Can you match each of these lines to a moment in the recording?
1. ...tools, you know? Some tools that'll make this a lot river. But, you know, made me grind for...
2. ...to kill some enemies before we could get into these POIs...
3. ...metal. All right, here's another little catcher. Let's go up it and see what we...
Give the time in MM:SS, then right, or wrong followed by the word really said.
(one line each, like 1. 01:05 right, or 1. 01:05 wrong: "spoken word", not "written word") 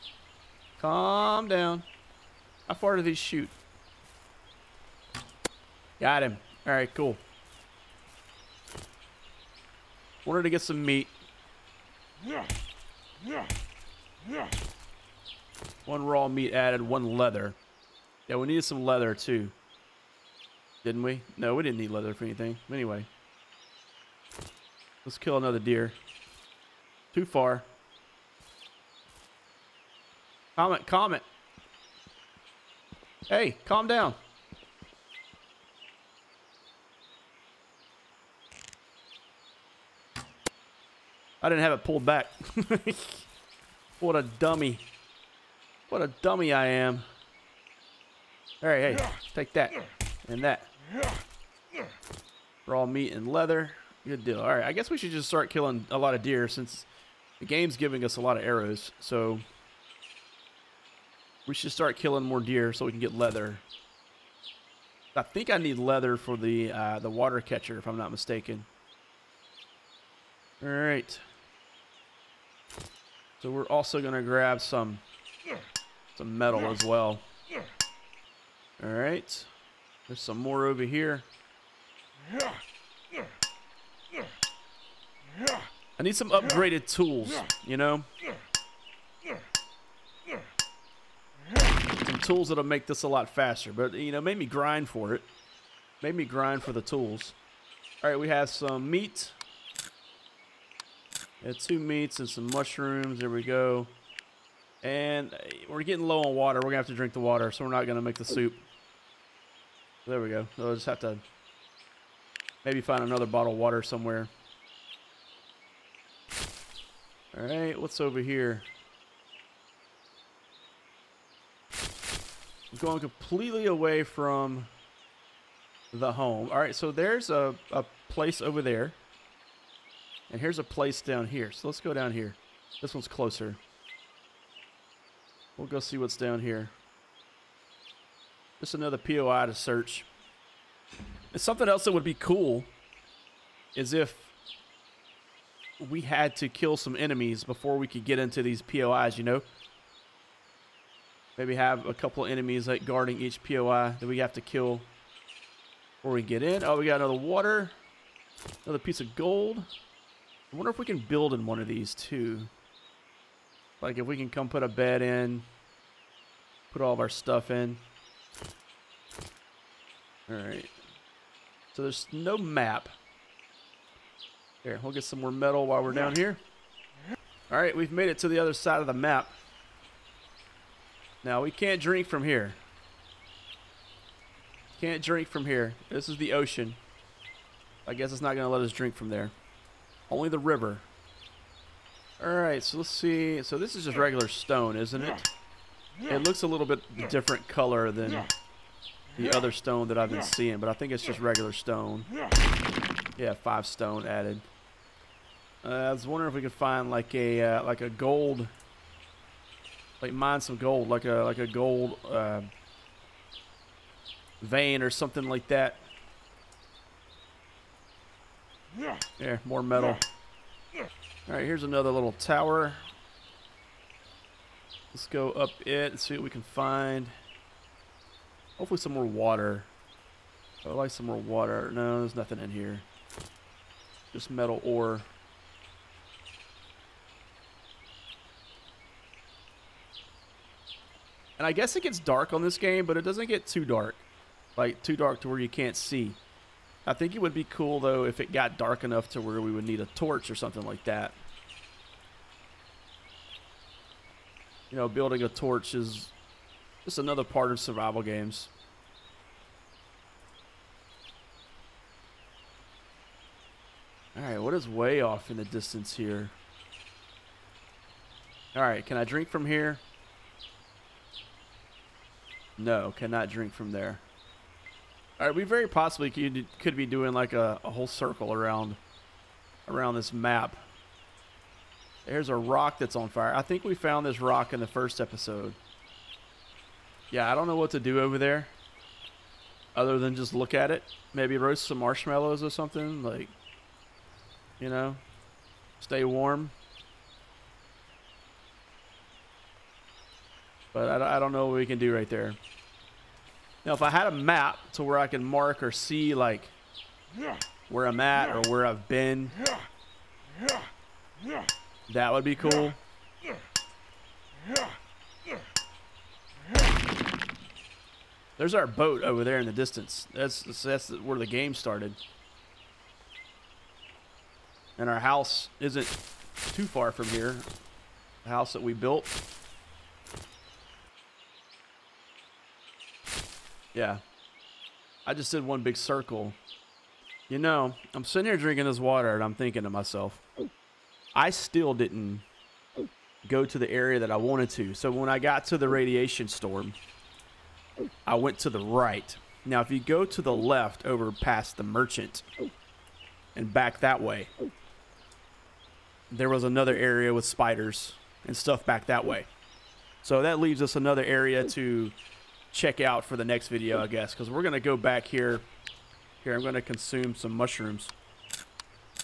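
1. 01:26 wrong: "faster", not "river"
2. 02:26 right
3. 03:39 wrong: "tower", not "catcher".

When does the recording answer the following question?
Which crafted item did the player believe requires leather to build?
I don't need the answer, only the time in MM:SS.
01:06.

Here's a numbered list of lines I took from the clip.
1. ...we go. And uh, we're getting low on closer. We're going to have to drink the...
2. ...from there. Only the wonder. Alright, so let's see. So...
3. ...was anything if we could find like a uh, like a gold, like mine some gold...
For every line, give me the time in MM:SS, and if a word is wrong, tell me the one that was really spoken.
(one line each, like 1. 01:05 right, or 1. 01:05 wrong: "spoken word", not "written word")
1. 01:43 wrong: "water", not "closer"
2. 03:08 wrong: "river", not "wonder"
3. 03:25 wrong: "wondering", not "anything".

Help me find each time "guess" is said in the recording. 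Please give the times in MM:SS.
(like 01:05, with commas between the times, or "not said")
00:54, 03:07, 04:01, 06:03.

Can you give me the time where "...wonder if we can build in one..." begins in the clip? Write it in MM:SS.
02:40.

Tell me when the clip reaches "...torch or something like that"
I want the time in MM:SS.
04:09.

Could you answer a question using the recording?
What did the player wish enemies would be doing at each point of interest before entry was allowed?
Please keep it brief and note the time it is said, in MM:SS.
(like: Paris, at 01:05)
Guarding, at 02:32.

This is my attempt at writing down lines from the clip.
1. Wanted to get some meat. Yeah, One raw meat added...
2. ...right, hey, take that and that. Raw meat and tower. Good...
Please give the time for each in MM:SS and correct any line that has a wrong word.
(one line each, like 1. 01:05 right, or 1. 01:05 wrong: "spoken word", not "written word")
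1. 00:10 right
2. 00:48 wrong: "leather", not "tower".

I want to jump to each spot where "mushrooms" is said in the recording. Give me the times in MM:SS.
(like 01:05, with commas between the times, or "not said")
01:42, 06:07.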